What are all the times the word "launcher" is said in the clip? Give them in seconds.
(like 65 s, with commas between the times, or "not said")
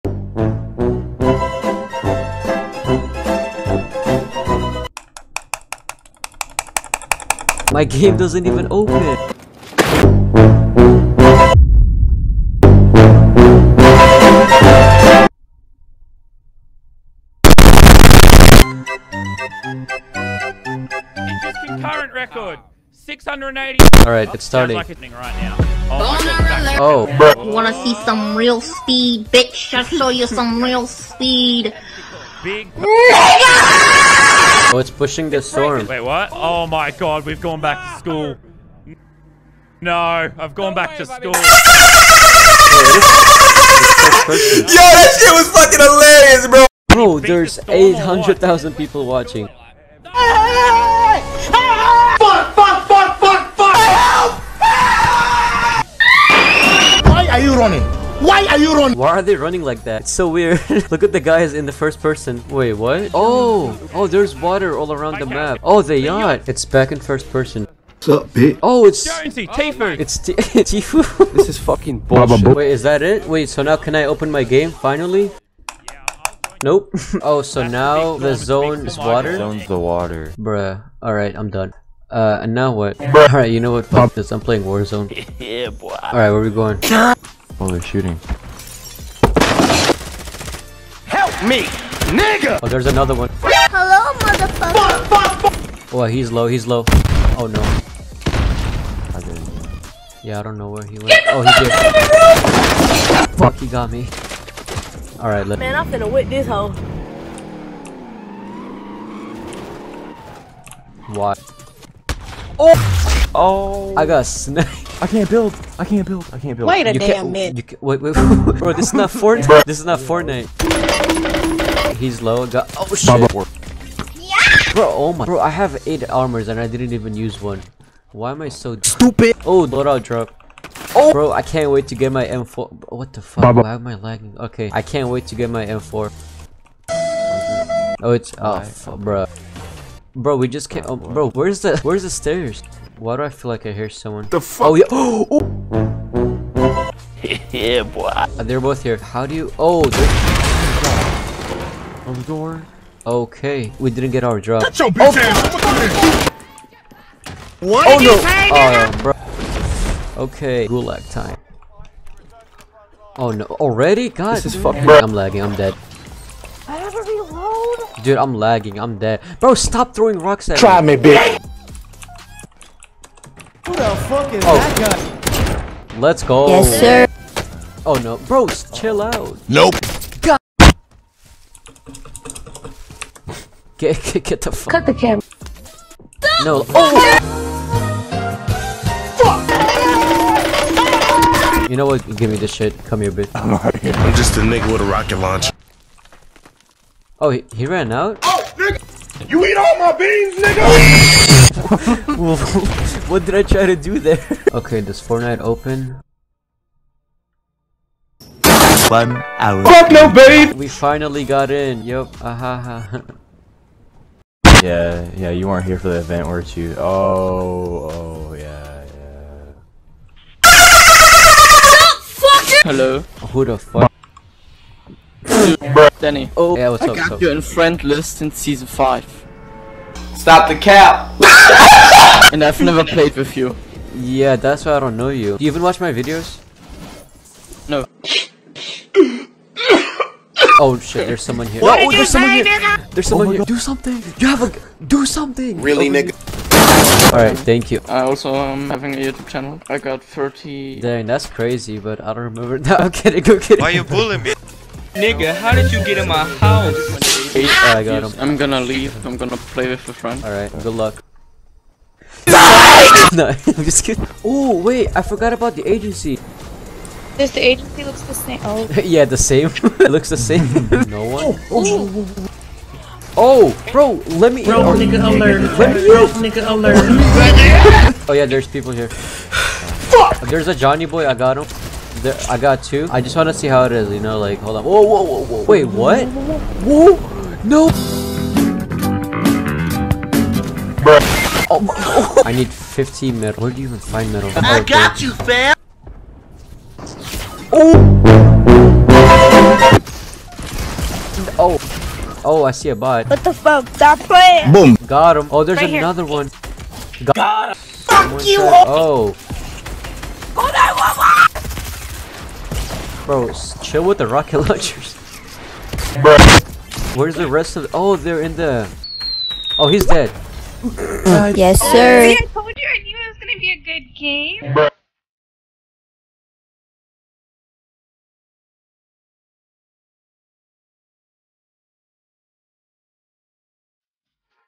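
195 s, 314 s.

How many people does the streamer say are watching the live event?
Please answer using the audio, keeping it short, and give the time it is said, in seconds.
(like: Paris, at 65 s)
800,000, at 47 s.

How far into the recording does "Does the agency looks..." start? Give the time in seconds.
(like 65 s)
267 s.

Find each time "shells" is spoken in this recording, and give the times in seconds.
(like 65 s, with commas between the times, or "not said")
not said.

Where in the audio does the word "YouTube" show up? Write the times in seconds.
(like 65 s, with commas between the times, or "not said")
248 s.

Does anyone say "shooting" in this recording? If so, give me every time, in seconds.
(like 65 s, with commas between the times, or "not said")
87 s.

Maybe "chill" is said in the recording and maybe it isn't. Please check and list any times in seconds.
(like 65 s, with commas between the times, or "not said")
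178 s, 313 s.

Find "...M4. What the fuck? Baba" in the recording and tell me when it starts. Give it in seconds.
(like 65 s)
132 s.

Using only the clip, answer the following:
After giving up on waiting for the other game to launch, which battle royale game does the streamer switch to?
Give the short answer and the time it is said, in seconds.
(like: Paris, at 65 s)
Warzone, at 84 s.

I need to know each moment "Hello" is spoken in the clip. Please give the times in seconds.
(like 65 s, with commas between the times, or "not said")
93 s, 222 s.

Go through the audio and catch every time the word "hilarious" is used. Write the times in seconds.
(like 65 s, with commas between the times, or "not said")
45 s.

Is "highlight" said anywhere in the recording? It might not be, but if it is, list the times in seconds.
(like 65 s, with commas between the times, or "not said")
not said.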